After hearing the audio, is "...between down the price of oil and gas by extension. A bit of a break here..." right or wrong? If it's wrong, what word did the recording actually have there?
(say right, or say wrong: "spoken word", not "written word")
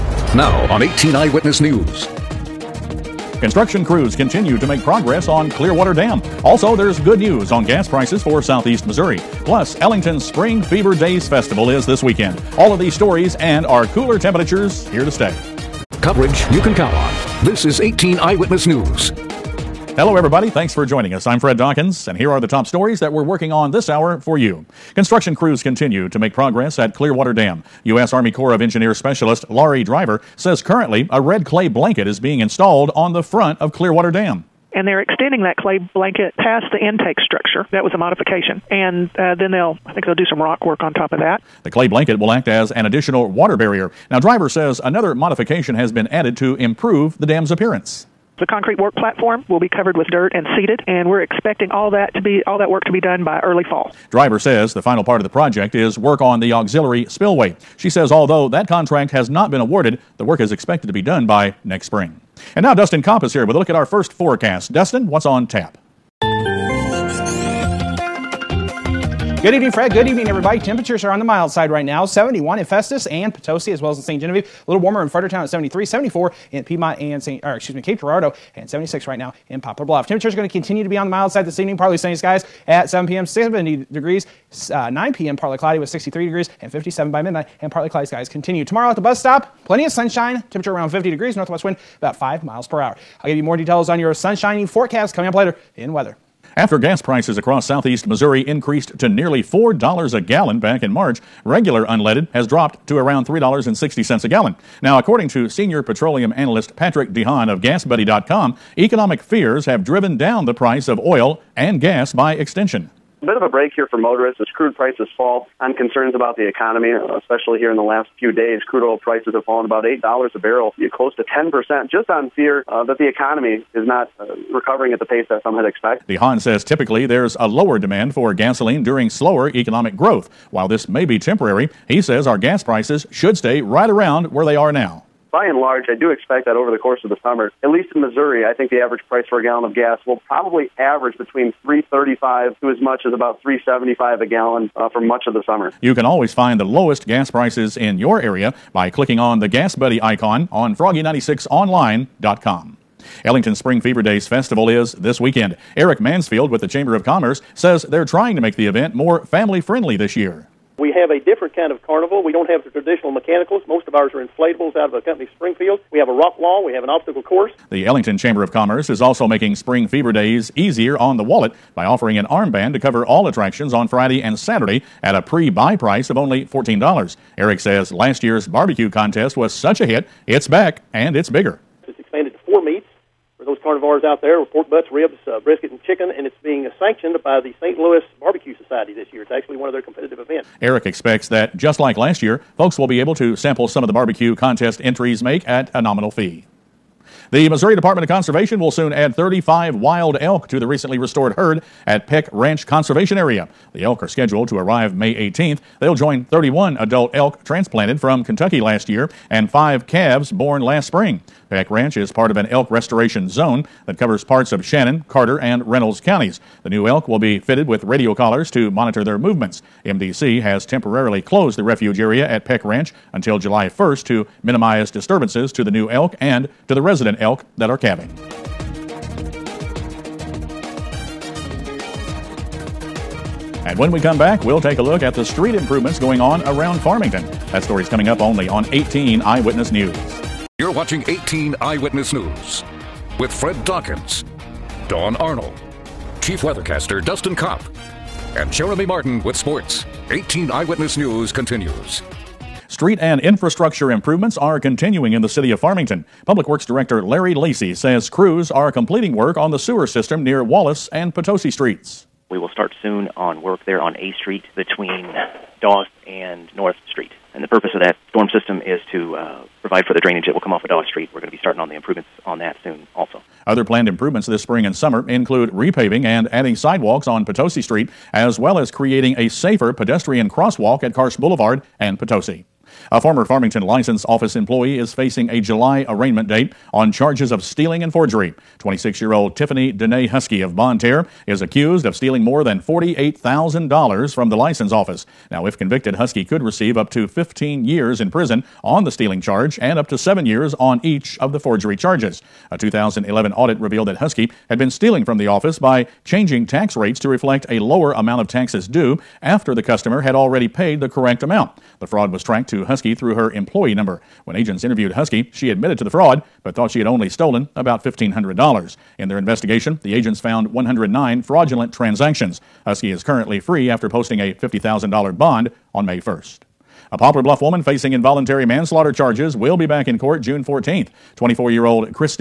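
wrong: "driven", not "between".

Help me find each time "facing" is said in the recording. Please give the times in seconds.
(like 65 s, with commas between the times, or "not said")
284 s, 327 s.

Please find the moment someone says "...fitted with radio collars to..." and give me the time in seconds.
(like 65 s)
217 s.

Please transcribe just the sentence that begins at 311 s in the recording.
The fraud was tracked to Husky through her employee number.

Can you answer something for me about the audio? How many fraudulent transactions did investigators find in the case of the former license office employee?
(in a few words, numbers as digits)
109.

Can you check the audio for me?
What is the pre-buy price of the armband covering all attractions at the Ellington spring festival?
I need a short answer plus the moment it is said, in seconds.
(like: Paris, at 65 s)
$14, at 176 s.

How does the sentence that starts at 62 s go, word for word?
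And now Dustin Kopp is here with a look at our first forecast.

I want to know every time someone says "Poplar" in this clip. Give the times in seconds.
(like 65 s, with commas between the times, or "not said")
79 s, 326 s.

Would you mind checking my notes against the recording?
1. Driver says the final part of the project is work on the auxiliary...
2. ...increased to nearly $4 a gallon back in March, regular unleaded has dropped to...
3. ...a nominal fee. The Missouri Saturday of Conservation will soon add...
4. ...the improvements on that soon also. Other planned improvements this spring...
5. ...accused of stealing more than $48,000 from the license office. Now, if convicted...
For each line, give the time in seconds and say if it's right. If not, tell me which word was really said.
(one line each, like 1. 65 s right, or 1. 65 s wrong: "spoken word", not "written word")
1. 54 s right
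2. 98 s right
3. 195 s wrong: "Department", not "Saturday"
4. 271 s right
5. 291 s right.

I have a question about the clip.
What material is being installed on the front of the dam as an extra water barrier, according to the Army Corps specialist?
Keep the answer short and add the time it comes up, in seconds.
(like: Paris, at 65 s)
Red clay blanket, at 31 s.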